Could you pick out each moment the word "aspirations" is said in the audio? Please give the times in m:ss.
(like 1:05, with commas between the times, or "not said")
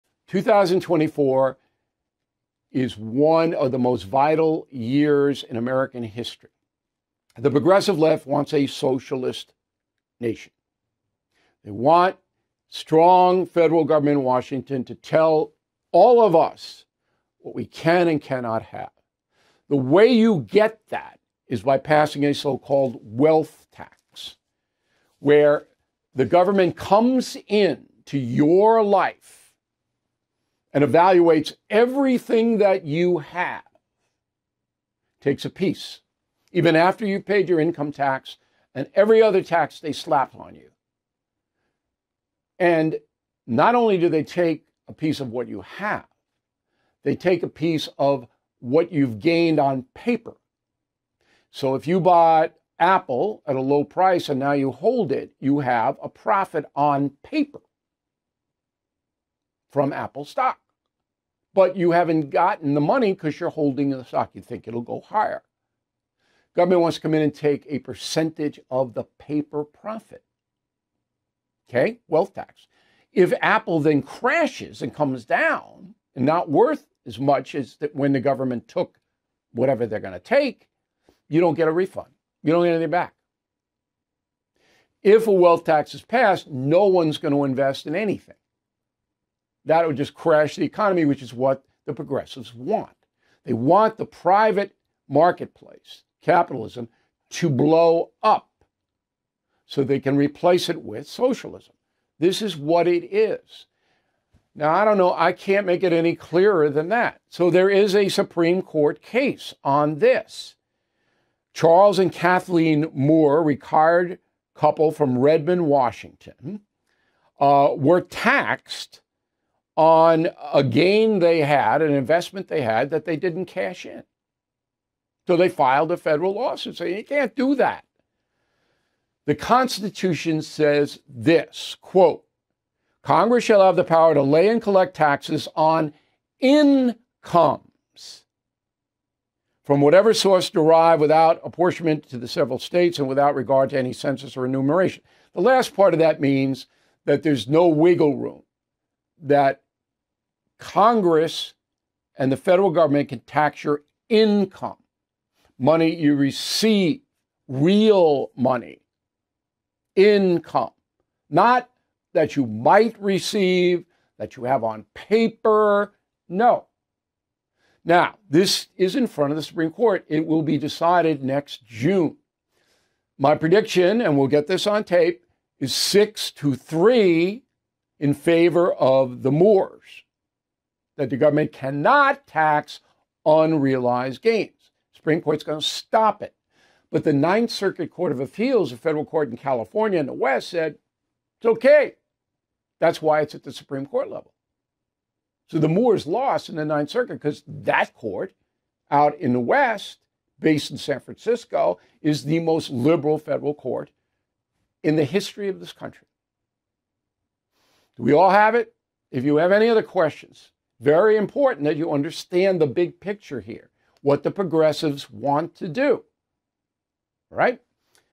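not said.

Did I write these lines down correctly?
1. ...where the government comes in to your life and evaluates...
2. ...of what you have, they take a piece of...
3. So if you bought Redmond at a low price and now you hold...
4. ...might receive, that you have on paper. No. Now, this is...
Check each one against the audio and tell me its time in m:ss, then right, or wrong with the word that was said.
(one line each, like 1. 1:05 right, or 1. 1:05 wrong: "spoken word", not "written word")
1. 0:25 right
2. 0:45 right
3. 0:51 wrong: "Apple", not "Redmond"
4. 2:42 right.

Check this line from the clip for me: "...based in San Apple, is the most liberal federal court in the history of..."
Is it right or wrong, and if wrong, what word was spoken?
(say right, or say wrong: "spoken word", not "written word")
wrong: "Francisco", not "Apple".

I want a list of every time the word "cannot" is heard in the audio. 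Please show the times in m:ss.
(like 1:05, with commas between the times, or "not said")
0:18, 3:01.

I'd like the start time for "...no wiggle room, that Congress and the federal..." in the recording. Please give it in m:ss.
2:27.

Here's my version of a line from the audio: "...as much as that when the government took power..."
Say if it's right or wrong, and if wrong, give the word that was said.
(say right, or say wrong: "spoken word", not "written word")
wrong: "whatever", not "power".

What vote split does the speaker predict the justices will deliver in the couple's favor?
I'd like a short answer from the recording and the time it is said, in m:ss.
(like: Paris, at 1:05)
6 to 3, at 2:55.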